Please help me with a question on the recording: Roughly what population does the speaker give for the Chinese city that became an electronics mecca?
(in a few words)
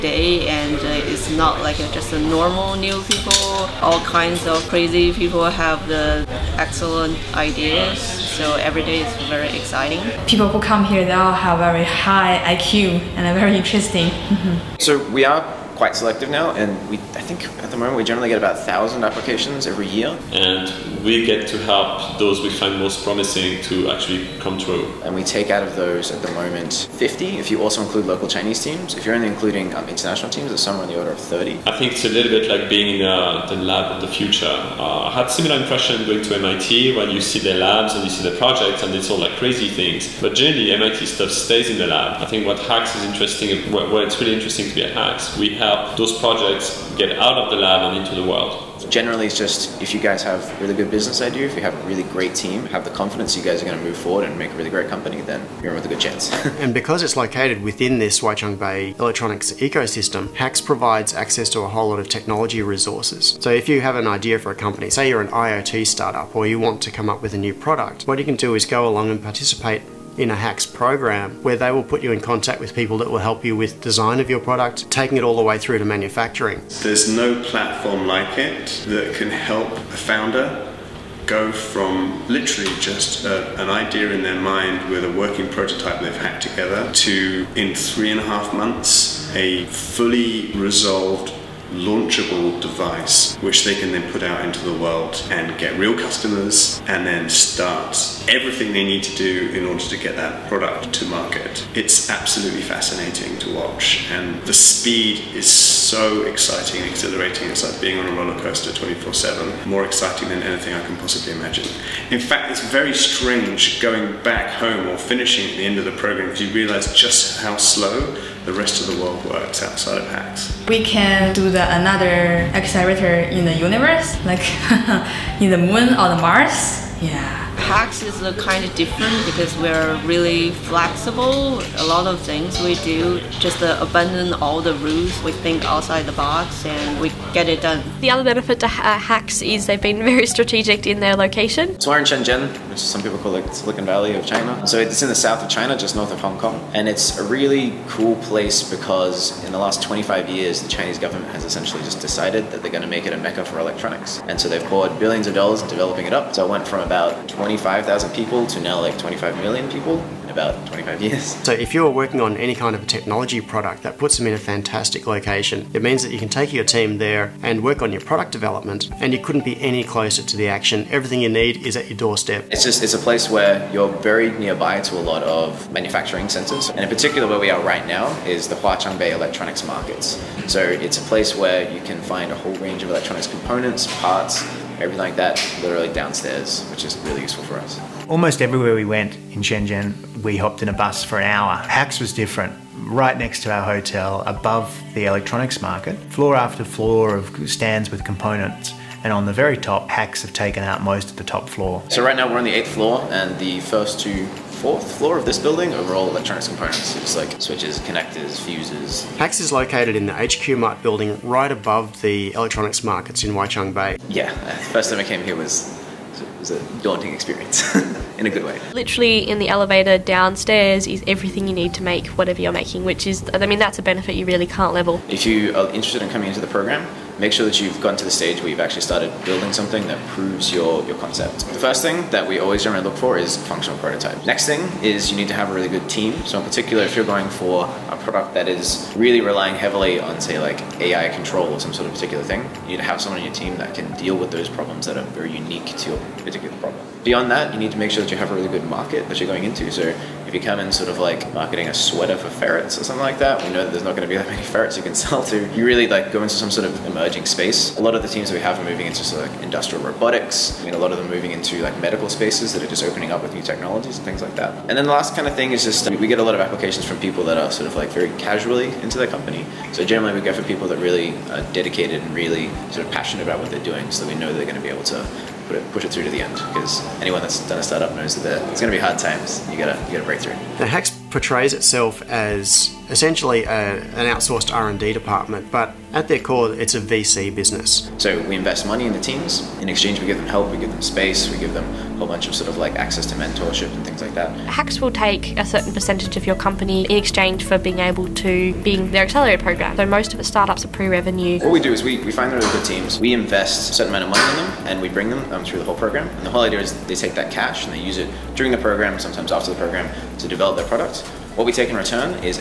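25 million.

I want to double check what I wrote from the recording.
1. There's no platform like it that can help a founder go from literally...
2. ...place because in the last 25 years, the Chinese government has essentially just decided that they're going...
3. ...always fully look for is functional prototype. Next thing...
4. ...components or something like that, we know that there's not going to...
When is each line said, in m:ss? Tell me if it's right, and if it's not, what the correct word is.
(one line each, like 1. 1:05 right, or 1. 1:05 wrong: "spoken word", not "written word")
1. 1:16 right
2. 2:28 right
3. 3:52 wrong: "generally", not "fully"
4. 4:12 wrong: "ferrets", not "components".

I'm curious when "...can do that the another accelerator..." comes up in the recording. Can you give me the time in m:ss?
2:00.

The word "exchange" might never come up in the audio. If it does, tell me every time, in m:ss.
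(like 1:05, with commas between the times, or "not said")
4:49, 4:56.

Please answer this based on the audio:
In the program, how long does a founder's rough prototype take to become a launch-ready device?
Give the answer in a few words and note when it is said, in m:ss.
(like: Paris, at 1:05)
three and a half months, at 1:27.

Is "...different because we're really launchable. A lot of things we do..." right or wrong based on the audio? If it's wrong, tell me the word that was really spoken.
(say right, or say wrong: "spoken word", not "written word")
wrong: "flexible", not "launchable".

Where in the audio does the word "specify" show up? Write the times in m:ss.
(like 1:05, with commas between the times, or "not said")
not said.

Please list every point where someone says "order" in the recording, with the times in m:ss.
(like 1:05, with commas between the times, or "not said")
0:30, 1:39.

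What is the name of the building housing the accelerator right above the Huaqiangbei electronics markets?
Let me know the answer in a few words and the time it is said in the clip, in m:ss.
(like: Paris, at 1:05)
HQ Mart, at 3:30.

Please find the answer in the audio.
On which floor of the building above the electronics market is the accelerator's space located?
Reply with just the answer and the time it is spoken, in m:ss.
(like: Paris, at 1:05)
eighth floor, at 3:22.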